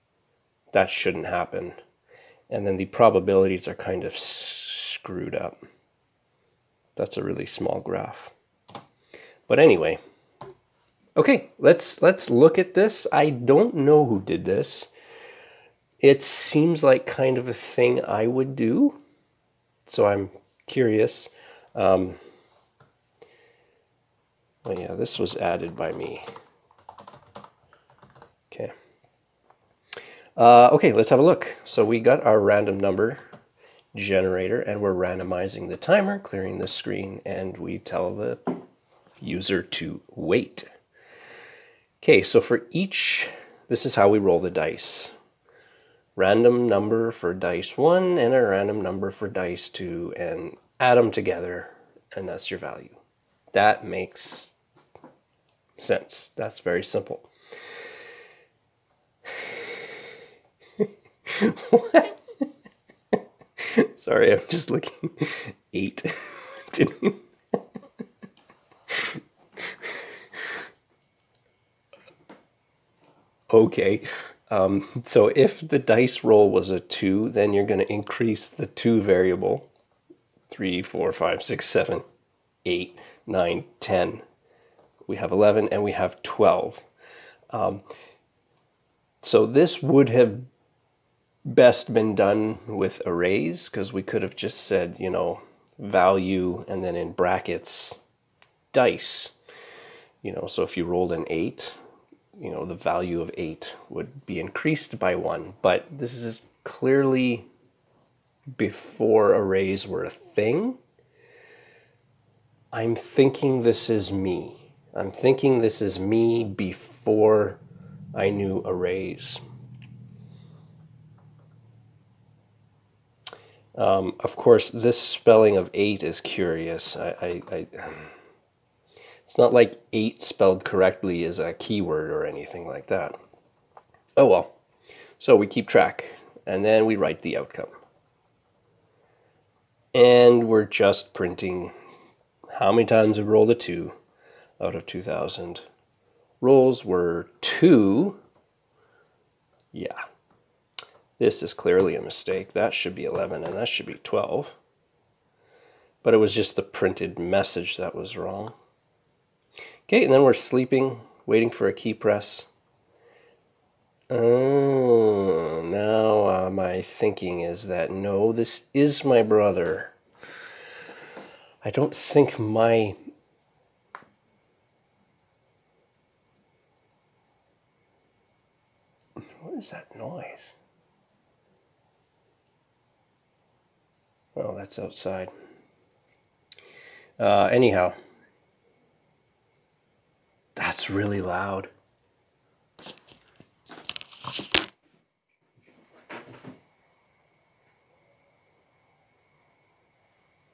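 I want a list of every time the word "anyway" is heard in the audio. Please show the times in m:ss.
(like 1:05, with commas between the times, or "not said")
0:09.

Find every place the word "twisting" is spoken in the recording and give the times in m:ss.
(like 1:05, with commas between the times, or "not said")
not said.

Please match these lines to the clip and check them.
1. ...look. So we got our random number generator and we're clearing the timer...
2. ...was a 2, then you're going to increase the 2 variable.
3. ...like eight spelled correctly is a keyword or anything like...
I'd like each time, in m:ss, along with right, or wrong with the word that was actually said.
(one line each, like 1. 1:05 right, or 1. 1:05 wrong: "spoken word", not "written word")
1. 0:31 wrong: "randomizing", not "clearing"
2. 1:16 right
3. 2:09 right.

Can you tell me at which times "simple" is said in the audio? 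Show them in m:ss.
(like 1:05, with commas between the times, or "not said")
0:56.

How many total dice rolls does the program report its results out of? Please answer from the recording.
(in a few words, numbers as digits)
2000.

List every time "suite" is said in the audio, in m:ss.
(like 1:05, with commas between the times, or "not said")
not said.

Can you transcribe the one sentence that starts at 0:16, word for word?
It seems like kind of a thing I would do, so I'm curious.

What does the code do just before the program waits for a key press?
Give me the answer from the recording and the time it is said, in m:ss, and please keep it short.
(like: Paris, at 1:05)
sleeping, at 2:40.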